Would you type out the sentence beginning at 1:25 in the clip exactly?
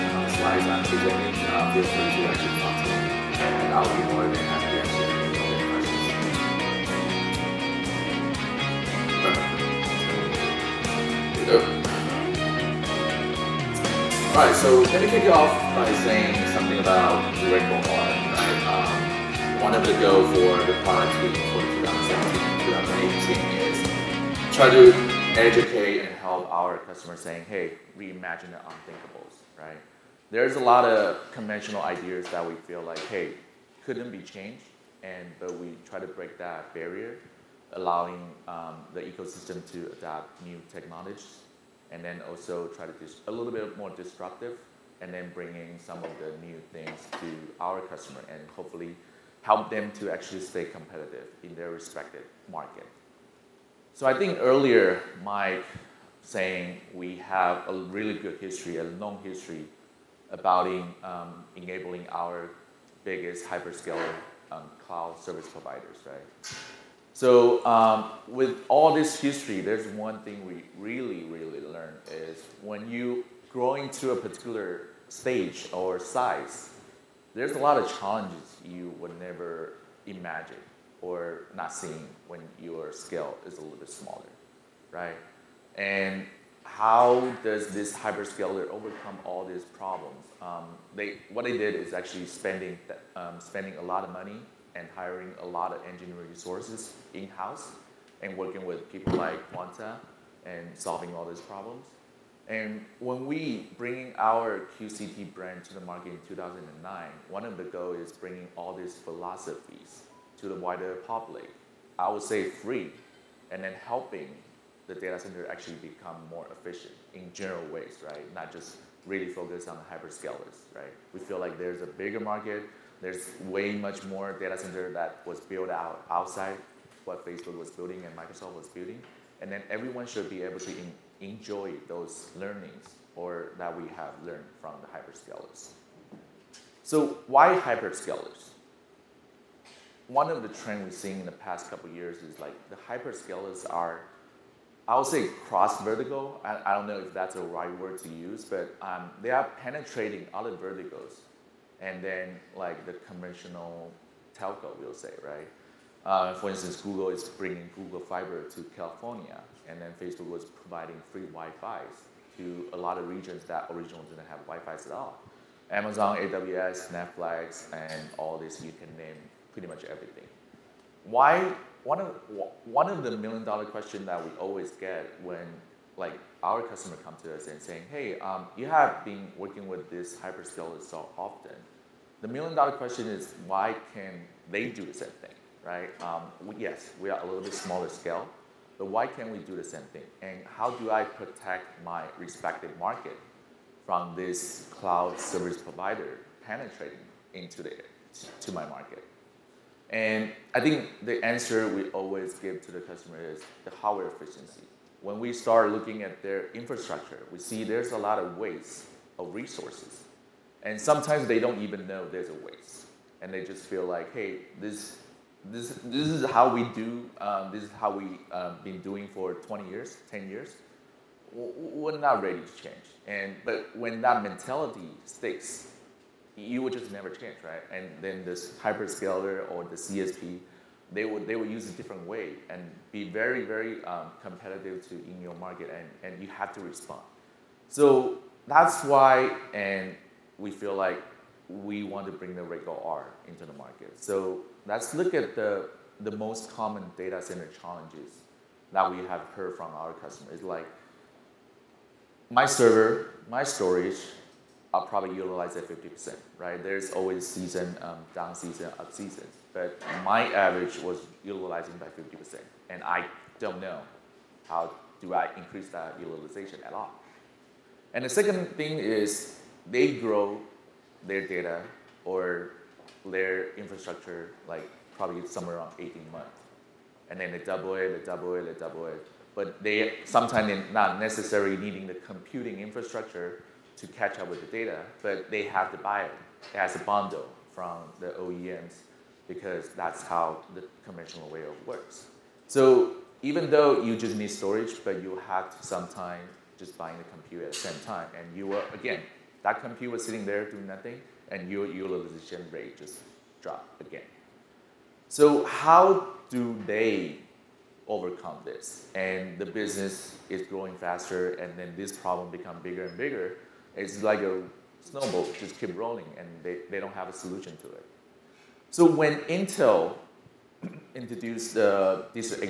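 And how does this hyperscaler overcome all these problems?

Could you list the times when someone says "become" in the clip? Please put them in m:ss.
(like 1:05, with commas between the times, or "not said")
1:55, 5:12.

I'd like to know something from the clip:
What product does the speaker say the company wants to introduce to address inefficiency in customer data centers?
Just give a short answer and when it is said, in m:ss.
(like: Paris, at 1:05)
Rackgo R, at 4:02.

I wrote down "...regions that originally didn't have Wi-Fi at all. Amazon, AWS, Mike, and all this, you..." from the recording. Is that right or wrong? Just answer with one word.
wrong.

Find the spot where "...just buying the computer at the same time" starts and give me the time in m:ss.
4:56.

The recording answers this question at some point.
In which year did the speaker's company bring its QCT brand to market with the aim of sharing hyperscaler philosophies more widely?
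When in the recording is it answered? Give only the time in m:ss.
1:46.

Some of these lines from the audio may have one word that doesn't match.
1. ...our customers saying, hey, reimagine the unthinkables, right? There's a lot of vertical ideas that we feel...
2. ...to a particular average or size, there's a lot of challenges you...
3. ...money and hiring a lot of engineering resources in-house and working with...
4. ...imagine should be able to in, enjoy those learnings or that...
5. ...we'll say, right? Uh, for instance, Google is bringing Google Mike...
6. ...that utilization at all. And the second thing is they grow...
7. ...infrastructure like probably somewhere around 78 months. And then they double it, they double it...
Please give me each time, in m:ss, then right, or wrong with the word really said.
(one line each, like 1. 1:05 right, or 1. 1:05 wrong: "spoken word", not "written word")
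1. 0:26 wrong: "conventional", not "vertical"
2. 1:13 wrong: "stage", not "average"
3. 1:34 right
4. 2:09 wrong: "everyone", not "imagine"
5. 2:34 wrong: "Fiber", not "Mike"
6. 4:25 right
7. 4:33 wrong: "18", not "78".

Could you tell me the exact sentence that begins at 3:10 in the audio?
And how do I protect my respective market from this cloud service provider penetrating into the, to my market?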